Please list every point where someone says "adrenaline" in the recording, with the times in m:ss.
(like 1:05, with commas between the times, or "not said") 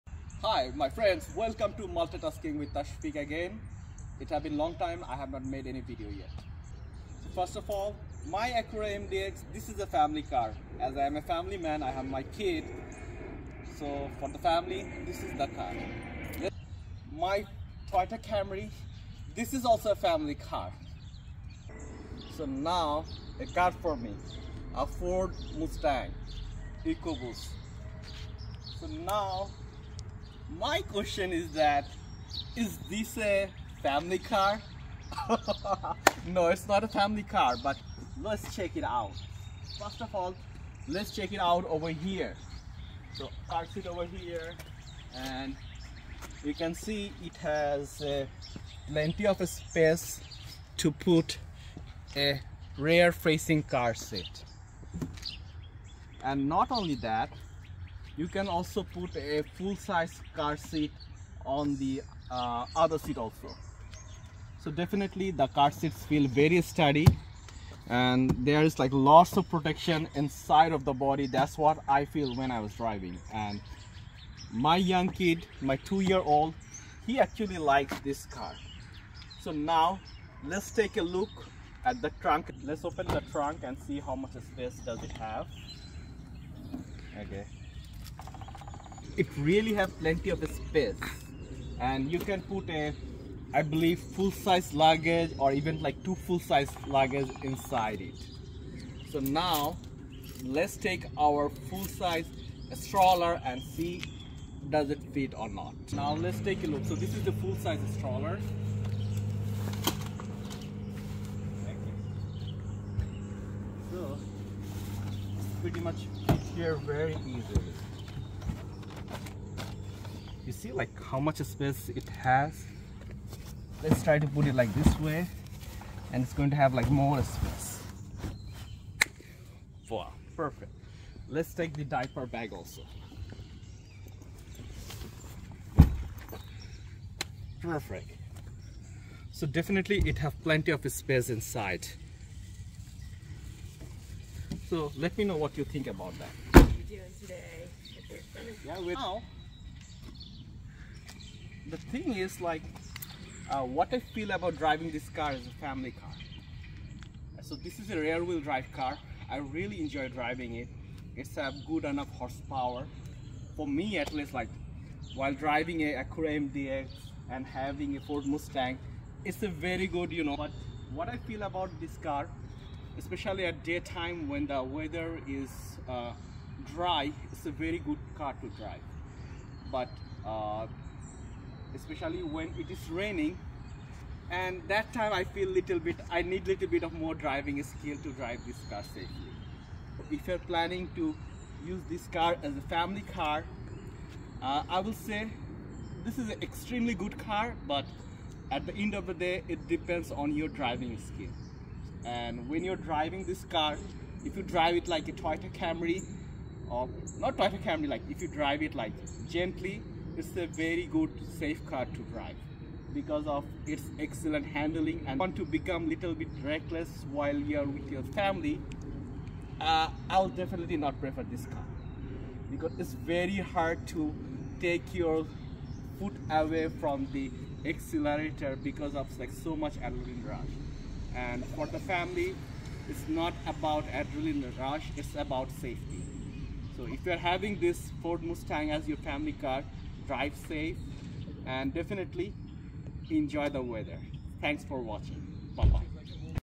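3:49, 3:53.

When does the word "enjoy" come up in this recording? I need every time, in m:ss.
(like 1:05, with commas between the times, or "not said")
2:39, 4:03.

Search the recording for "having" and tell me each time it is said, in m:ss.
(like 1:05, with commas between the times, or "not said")
2:47, 3:57.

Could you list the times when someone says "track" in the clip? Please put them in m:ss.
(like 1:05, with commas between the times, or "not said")
not said.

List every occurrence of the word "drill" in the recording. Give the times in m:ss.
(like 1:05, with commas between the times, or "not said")
not said.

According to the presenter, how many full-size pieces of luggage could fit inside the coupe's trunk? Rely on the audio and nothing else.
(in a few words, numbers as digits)
2.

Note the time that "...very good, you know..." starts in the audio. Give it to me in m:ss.
2:49.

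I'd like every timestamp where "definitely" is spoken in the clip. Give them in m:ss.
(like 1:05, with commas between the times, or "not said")
1:04, 2:19, 3:40, 4:01.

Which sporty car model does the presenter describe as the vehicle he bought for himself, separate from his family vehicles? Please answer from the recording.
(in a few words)
Ford Mustang EcoBoost.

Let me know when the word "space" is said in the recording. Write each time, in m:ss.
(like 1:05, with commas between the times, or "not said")
0:49, 1:24, 1:30, 2:01, 2:07, 2:20.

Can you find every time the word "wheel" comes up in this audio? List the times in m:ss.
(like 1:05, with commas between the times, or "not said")
2:38.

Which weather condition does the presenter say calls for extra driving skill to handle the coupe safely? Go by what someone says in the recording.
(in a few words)
Raining.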